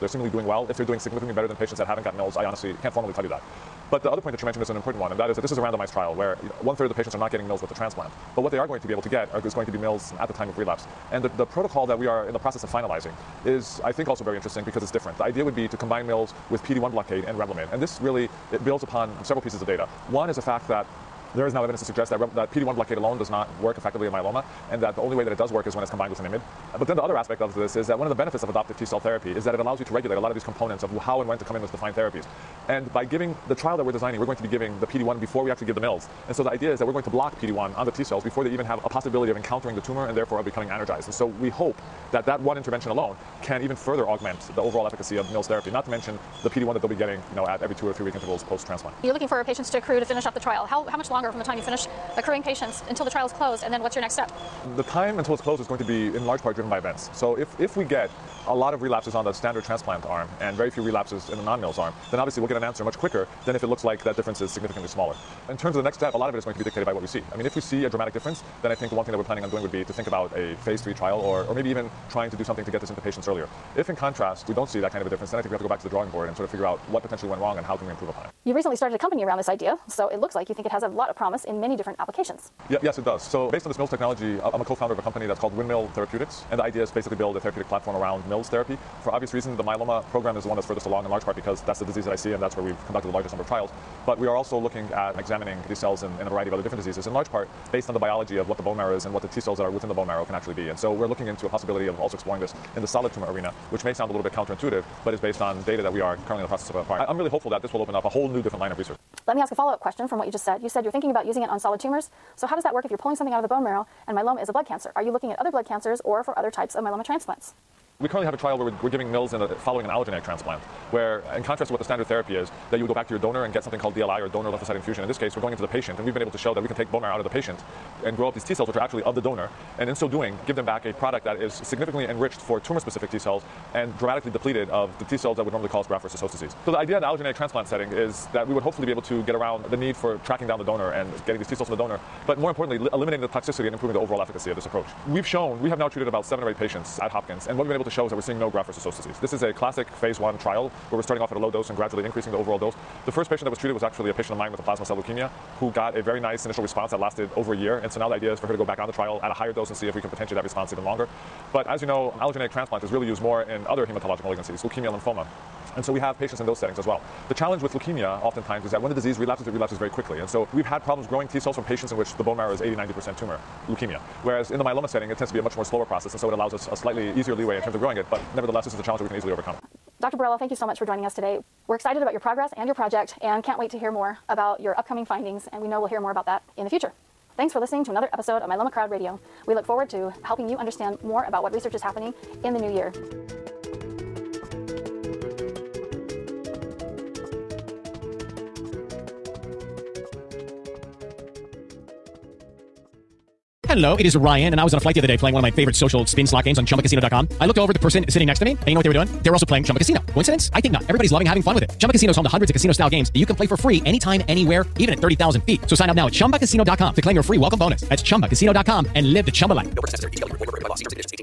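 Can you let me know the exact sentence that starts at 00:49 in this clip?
You're looking for patients to accrue to finish up the trial.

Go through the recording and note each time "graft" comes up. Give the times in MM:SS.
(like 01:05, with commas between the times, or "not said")
02:15, 02:28.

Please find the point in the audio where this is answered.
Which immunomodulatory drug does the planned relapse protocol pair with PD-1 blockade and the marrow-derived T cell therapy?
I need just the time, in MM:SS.
00:17.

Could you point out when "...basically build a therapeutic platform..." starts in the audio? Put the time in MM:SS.
01:26.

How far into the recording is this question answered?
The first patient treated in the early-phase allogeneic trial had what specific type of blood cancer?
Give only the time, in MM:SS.
02:34.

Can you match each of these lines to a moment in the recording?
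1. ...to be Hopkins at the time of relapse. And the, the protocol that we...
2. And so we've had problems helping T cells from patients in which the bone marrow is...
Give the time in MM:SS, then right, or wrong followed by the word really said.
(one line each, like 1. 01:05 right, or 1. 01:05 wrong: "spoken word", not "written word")
1. 00:09 wrong: "MILS", not "Hopkins"
2. 02:50 wrong: "growing", not "helping".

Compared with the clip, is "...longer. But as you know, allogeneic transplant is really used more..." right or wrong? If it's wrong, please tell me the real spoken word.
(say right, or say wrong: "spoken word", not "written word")
right.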